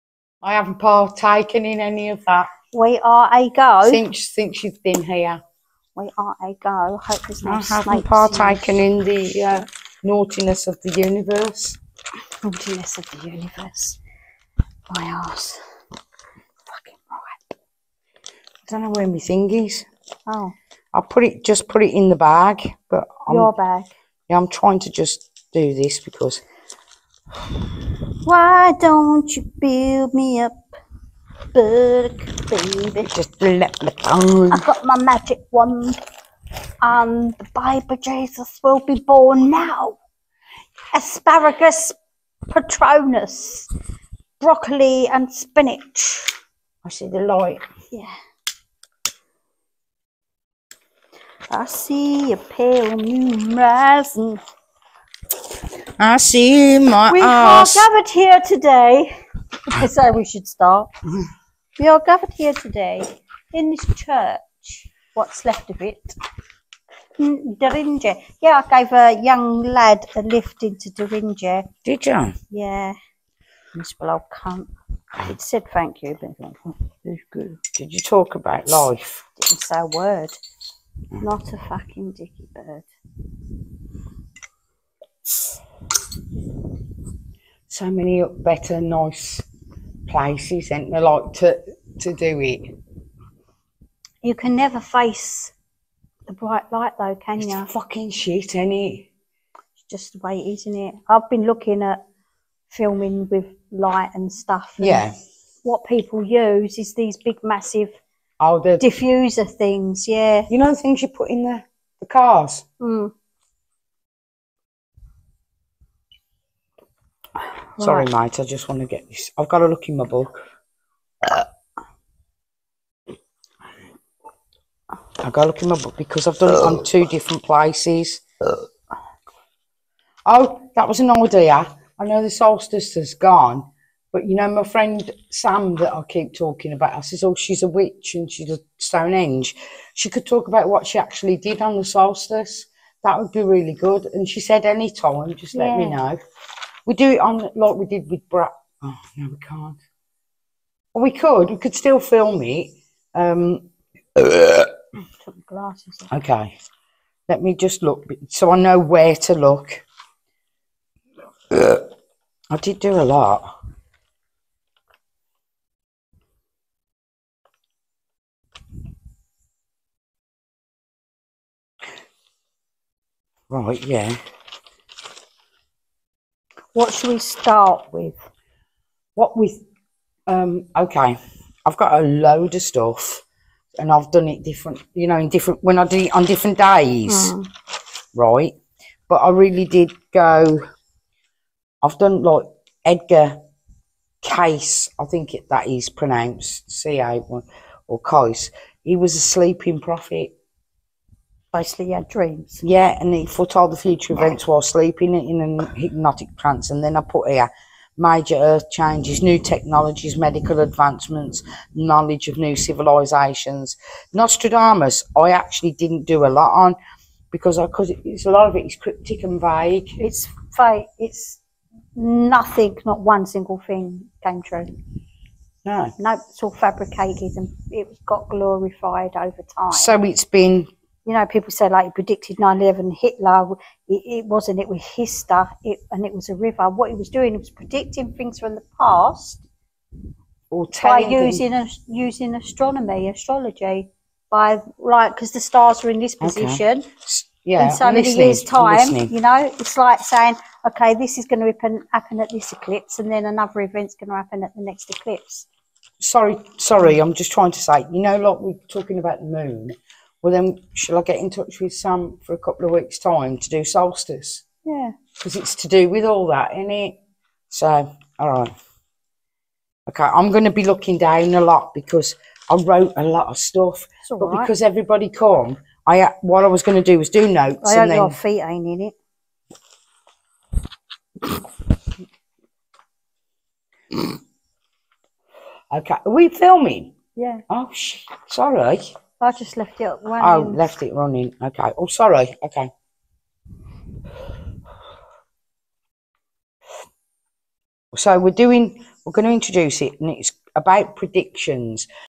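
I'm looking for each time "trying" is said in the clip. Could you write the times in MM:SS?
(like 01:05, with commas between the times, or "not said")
00:24, 04:17.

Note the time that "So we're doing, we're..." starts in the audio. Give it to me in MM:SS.
04:57.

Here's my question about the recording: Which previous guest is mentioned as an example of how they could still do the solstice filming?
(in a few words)
Brad.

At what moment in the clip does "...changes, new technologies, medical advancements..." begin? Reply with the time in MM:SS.
03:28.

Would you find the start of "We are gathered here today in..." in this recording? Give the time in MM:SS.
01:01.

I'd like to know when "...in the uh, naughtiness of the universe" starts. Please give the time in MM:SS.
00:08.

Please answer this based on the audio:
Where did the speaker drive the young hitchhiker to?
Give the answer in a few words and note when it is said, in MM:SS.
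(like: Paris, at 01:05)
Doringe, at 01:10.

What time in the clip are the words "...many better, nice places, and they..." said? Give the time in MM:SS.
01:27.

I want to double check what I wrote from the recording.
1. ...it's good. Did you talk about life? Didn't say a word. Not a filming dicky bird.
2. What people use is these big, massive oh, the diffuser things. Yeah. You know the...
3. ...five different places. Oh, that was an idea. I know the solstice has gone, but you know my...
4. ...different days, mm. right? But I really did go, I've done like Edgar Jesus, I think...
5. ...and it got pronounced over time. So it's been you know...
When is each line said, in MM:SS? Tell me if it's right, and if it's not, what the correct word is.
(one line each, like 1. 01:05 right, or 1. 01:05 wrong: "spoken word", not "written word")
1. 01:17 wrong: "fucking", not "filming"
2. 01:45 right
3. 02:06 wrong: "two", not "five"
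4. 03:06 wrong: "Cayce", not "Jesus"
5. 03:47 wrong: "glorified", not "pronounced".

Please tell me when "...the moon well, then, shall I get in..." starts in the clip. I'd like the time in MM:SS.
04:19.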